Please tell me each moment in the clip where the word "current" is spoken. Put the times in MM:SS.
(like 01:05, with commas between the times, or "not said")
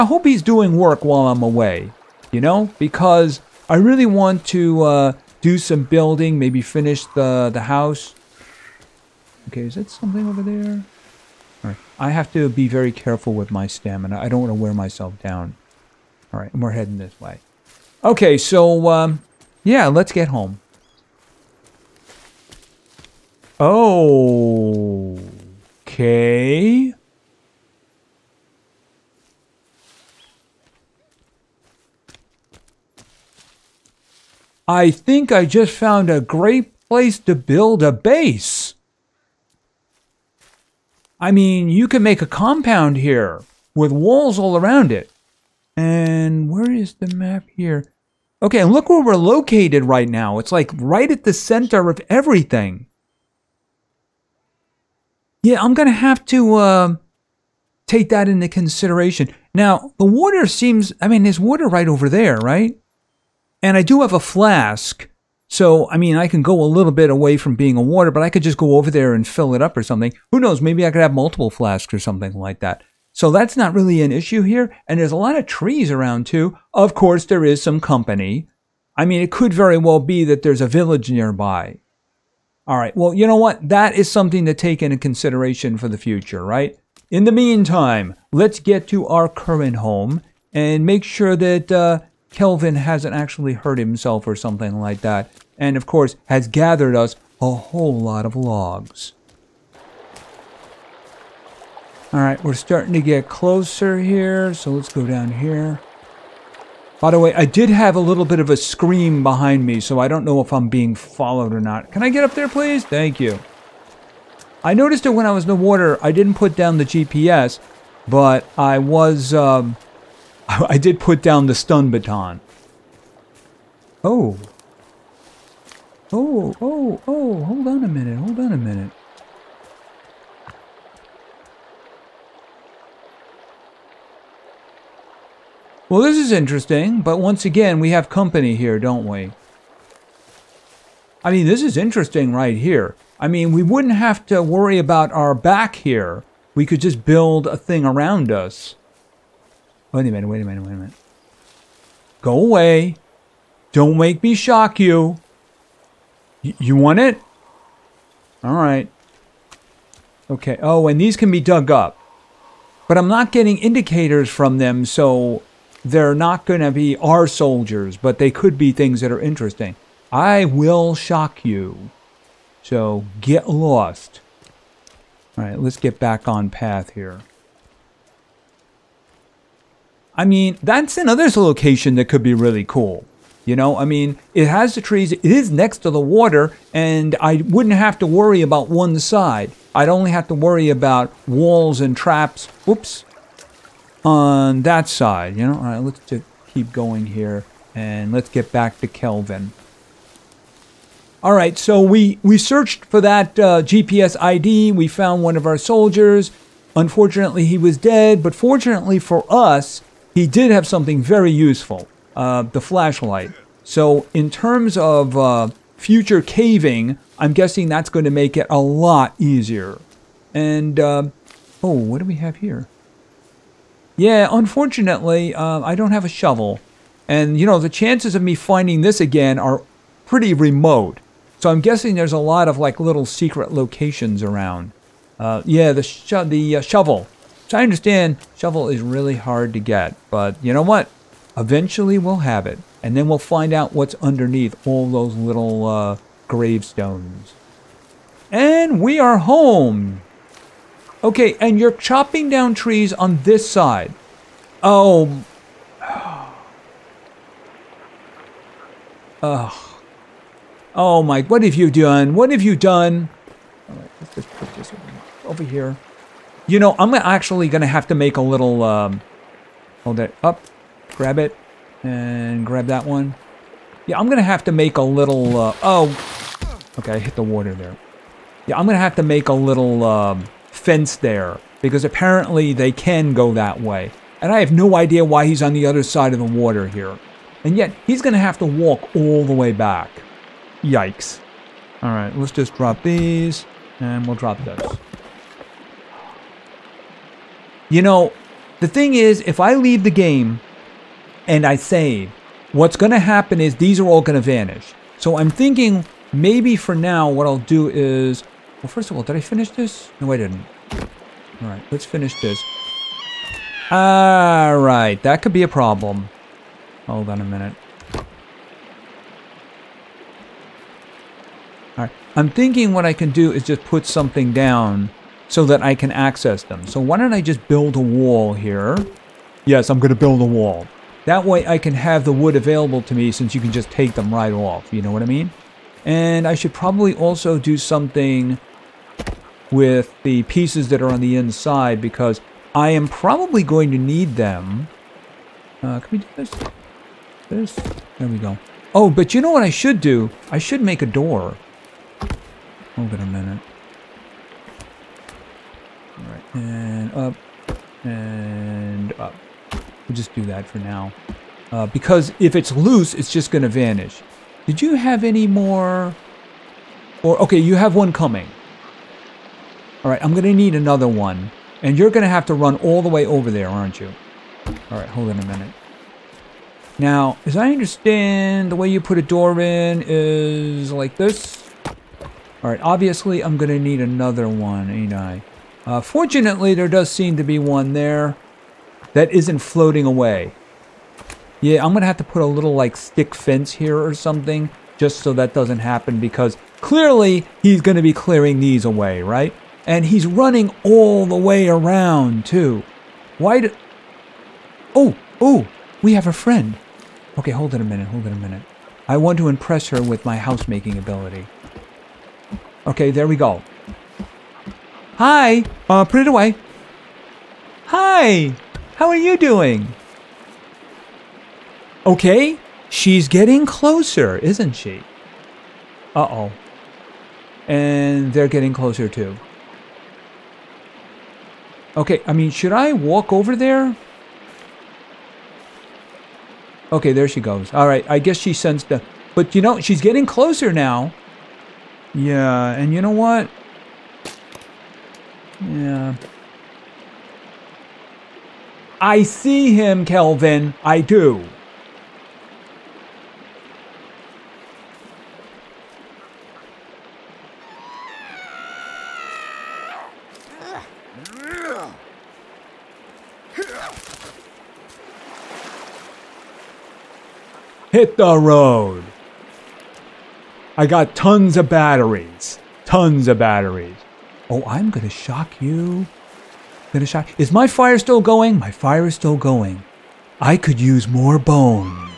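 01:29.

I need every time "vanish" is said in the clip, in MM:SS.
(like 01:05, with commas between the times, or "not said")
05:04, 06:03.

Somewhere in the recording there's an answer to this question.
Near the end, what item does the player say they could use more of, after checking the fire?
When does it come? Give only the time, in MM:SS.
08:00.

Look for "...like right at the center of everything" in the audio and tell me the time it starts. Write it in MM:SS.
00:50.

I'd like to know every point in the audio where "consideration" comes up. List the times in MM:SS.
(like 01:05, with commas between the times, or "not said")
00:58, 01:24.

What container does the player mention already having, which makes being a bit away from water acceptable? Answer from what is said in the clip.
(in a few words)
flask.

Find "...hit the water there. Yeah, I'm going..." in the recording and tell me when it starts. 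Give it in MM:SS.
04:36.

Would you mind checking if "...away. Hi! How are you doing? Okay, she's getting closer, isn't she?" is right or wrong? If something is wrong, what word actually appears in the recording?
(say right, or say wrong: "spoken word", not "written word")
right.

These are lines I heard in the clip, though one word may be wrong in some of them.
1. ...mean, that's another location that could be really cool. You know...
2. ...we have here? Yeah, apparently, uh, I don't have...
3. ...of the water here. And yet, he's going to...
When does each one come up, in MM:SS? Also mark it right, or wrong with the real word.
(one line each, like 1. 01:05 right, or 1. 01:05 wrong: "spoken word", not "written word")
1. 03:00 right
2. 03:42 wrong: "unfortunately", not "apparently"
3. 04:46 right.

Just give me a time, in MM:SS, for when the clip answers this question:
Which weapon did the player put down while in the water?
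02:01.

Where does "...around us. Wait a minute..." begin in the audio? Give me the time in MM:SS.
02:27.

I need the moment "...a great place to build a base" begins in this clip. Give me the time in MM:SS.
00:36.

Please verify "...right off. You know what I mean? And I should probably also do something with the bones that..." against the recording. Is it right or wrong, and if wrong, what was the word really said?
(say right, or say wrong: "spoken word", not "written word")
wrong: "pieces", not "bones".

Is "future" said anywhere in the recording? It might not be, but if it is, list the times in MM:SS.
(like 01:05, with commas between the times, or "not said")
01:25, 03:35.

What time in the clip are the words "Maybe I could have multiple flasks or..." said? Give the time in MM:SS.
01:10.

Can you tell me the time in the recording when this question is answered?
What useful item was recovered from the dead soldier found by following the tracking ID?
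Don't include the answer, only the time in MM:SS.
03:32.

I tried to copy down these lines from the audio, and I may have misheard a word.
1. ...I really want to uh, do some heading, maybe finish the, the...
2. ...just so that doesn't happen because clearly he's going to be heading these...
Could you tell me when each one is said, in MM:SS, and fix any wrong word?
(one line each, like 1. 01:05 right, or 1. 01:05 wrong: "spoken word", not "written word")
1. 00:03 wrong: "building", not "heading"
2. 06:34 wrong: "clearing", not "heading".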